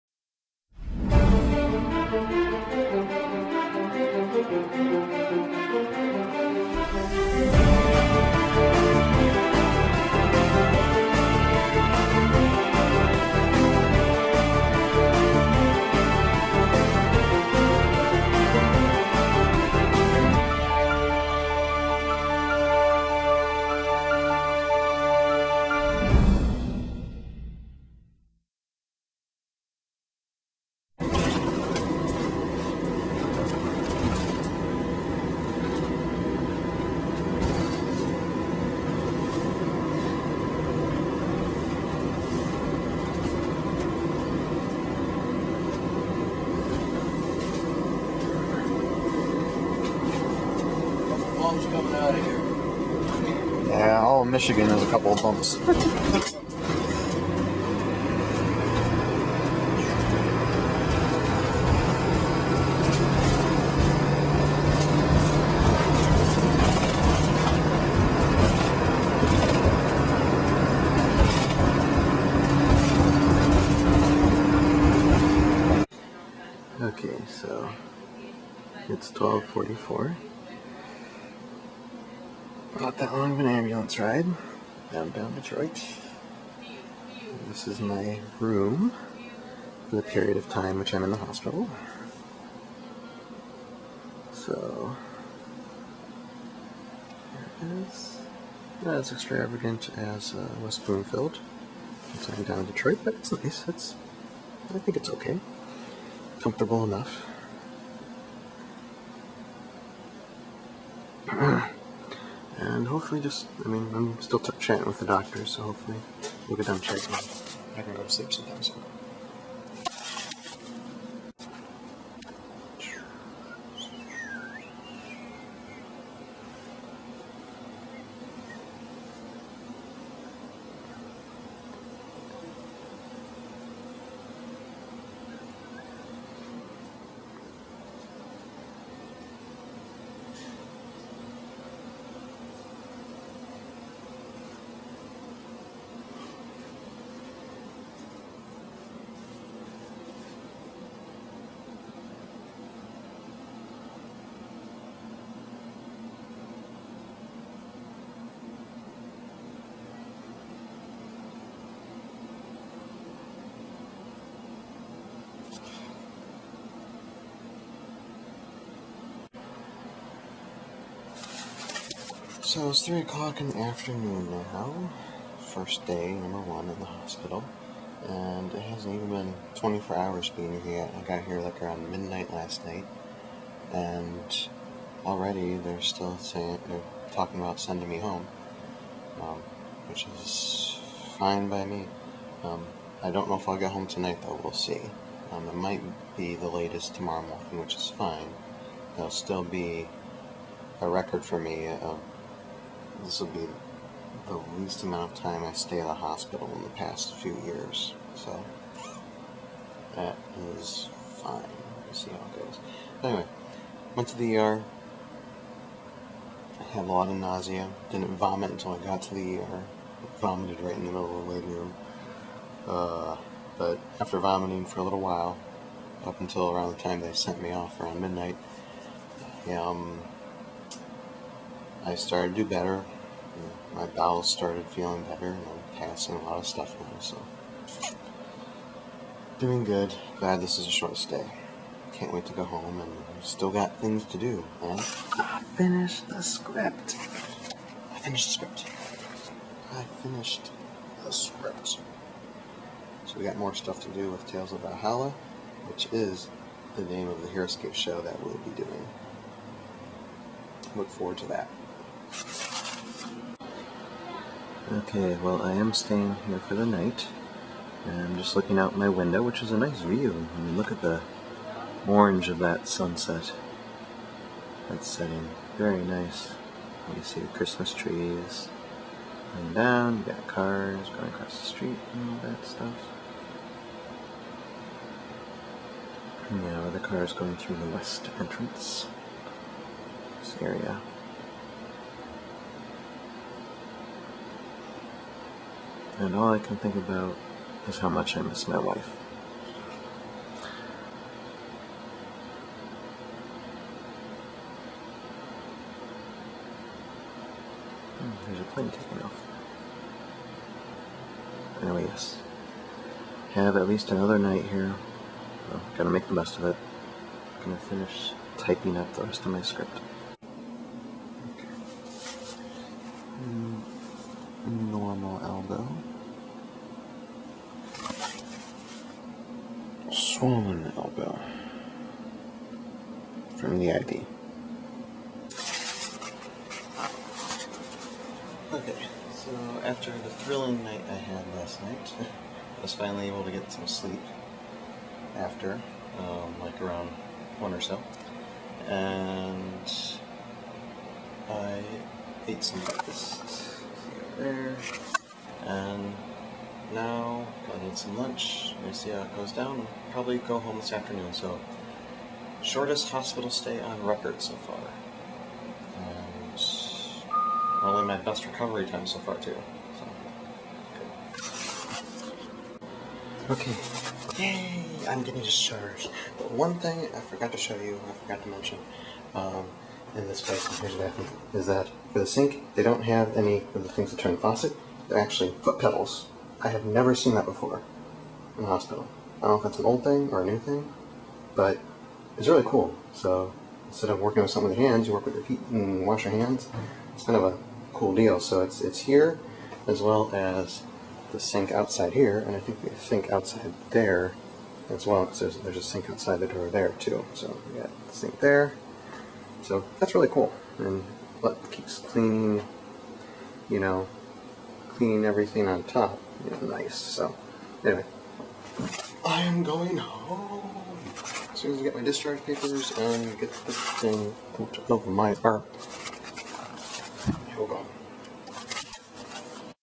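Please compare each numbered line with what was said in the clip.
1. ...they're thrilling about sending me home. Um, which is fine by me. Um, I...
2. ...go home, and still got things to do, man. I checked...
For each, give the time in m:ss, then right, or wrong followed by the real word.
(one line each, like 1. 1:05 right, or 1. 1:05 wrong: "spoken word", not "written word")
1. 3:06 wrong: "talking", not "thrilling"
2. 4:02 wrong: "finished", not "checked".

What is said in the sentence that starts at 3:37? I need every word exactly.
Didn't vomit until I got to the ER.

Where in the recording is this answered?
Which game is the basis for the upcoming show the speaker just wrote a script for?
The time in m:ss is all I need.
4:17.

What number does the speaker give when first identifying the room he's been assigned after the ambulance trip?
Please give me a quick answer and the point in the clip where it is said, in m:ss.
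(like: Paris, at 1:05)
1244, at 1:19.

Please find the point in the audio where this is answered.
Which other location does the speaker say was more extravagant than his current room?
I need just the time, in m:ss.
1:40.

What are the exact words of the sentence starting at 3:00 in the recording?
I got here like around midnight last night.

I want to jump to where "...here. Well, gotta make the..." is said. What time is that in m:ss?
5:14.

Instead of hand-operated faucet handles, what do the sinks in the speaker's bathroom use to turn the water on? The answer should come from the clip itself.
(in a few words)
foot pedals.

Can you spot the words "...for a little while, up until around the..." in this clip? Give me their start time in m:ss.
3:44.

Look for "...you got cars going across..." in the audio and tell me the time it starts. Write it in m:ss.
4:39.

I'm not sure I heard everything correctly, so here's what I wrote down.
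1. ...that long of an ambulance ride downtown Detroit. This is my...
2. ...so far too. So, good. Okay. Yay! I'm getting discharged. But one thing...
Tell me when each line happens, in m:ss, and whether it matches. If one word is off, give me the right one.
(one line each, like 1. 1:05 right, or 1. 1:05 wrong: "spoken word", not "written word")
1. 1:22 right
2. 6:08 right.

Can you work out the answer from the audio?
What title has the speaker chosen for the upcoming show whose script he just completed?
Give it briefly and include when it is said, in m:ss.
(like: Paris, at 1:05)
Tales of Valhalla, at 4:14.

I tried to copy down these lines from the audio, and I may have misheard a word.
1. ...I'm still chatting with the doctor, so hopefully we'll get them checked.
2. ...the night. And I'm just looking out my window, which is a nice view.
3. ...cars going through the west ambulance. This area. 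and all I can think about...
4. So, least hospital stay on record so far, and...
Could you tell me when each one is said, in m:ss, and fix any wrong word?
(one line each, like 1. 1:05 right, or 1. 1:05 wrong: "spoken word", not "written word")
1. 1:53 right
2. 4:26 right
3. 4:46 wrong: "entrance", not "ambulance"
4. 6:01 wrong: "shortest", not "least".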